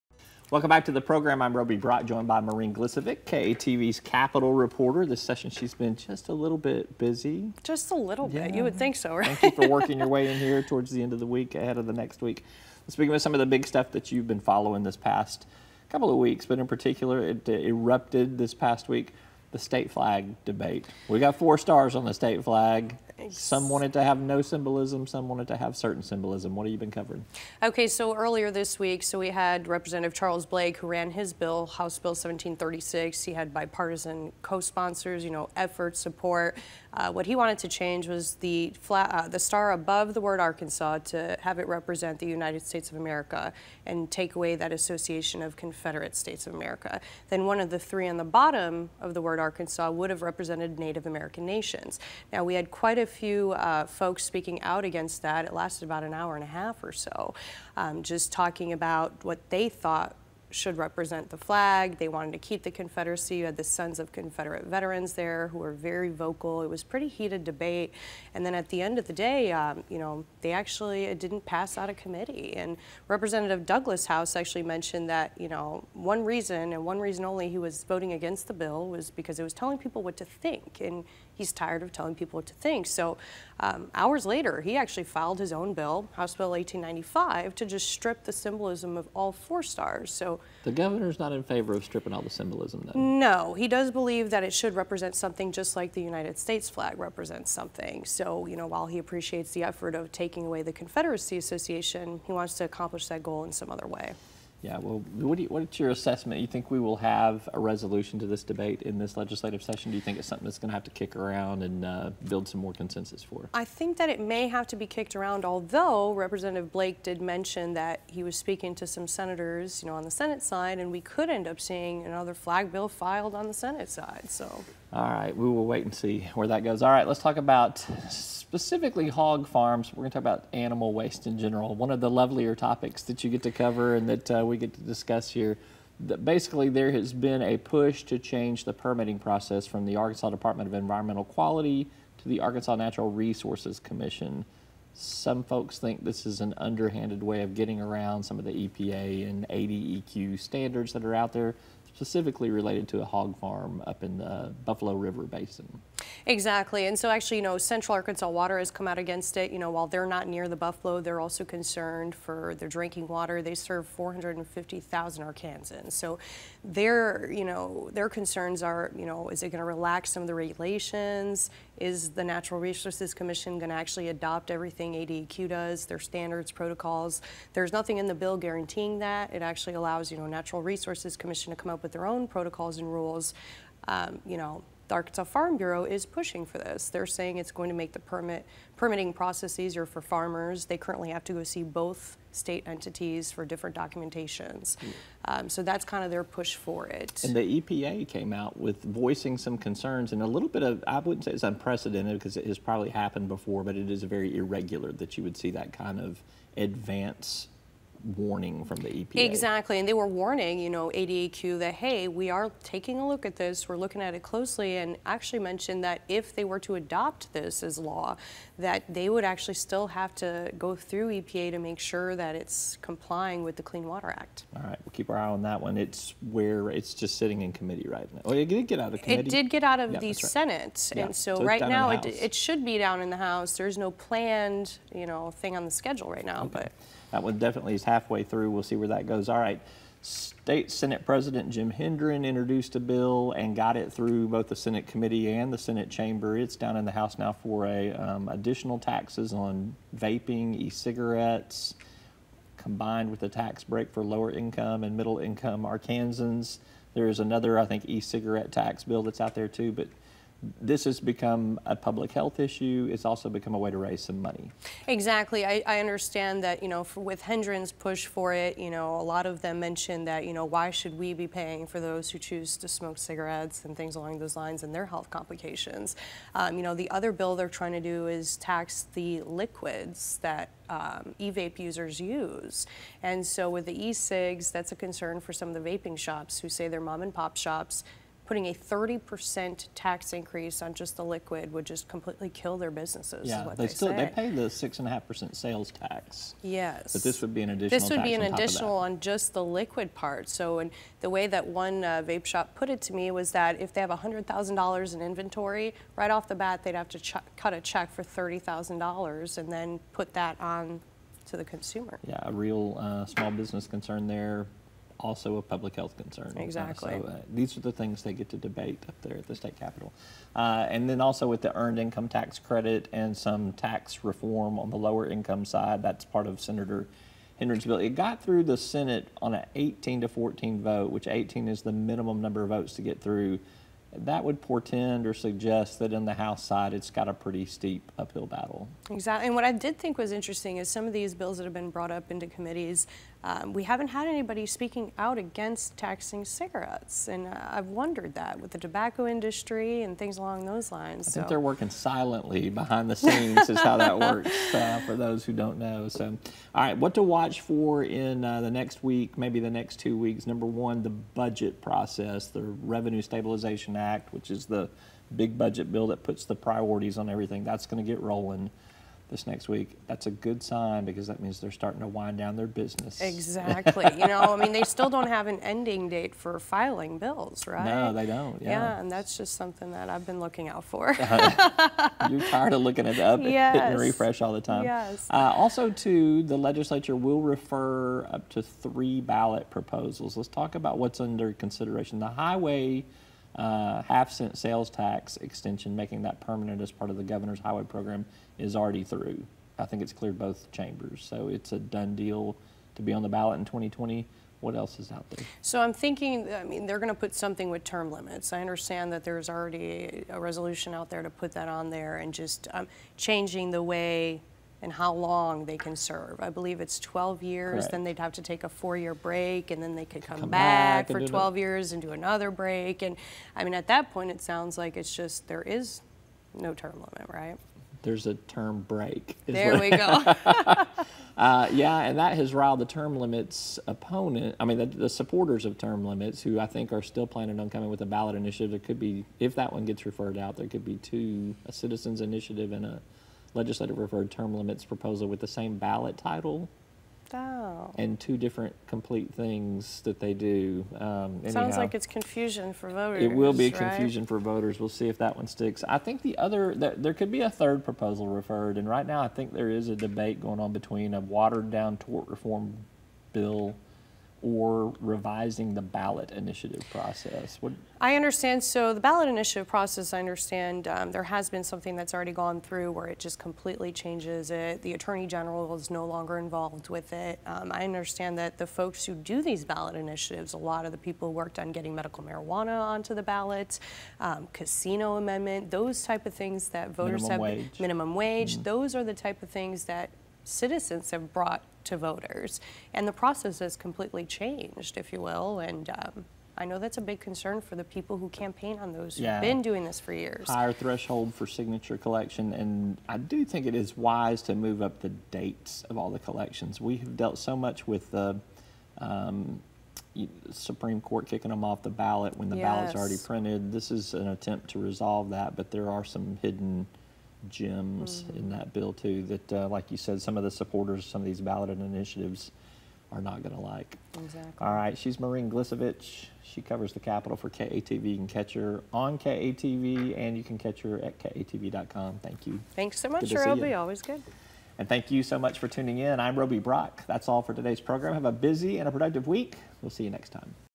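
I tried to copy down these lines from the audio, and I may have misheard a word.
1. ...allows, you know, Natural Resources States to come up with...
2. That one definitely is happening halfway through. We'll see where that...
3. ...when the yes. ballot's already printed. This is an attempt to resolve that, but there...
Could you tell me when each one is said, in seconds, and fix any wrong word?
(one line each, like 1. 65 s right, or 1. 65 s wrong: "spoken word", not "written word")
1. 179 s wrong: "Commission", not "States"
2. 237 s right
3. 512 s right.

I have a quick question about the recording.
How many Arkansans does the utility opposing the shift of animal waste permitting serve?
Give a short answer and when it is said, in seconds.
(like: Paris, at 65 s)
450,000, at 163 s.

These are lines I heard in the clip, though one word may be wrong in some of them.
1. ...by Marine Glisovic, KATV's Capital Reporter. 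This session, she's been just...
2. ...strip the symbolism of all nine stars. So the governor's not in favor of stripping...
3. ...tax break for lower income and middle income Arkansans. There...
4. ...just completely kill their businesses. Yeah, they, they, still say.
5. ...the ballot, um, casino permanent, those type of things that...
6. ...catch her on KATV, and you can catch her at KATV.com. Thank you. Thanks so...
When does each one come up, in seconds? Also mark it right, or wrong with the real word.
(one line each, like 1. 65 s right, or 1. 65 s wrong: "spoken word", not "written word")
1. 2 s right
2. 87 s wrong: "four", not "nine"
3. 253 s right
4. 291 s right
5. 482 s wrong: "amendment", not "permanent"
6. 528 s right.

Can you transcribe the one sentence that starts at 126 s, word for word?
All right, let's talk about specifically hog farms.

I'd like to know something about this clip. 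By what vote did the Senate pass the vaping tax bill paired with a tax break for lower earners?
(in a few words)
18 to 14.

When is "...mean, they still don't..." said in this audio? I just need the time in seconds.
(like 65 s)
374 s.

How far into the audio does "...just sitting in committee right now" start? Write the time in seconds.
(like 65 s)
226 s.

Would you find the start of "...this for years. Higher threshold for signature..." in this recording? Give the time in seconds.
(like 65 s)
499 s.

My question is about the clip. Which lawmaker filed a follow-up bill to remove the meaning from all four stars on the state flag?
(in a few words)
Douglas House.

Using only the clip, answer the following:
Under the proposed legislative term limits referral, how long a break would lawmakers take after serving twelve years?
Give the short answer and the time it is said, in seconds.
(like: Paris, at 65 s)
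4 years, at 418 s.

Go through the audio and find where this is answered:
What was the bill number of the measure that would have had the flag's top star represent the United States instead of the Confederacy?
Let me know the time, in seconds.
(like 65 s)
31 s.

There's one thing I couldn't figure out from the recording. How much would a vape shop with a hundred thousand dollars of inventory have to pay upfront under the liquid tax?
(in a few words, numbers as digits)
$30,000.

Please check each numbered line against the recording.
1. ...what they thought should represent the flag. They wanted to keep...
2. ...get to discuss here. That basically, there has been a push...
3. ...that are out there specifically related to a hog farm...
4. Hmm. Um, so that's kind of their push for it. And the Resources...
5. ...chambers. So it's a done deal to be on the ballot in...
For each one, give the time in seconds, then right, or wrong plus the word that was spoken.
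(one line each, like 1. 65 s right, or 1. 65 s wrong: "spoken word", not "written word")
1. 59 s right
2. 134 s right
3. 150 s right
4. 194 s wrong: "EPA", not "Resources"
5. 400 s right.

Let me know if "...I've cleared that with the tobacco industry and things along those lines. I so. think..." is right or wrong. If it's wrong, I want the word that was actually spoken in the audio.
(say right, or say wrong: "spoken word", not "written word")
wrong: "wondered", not "cleared".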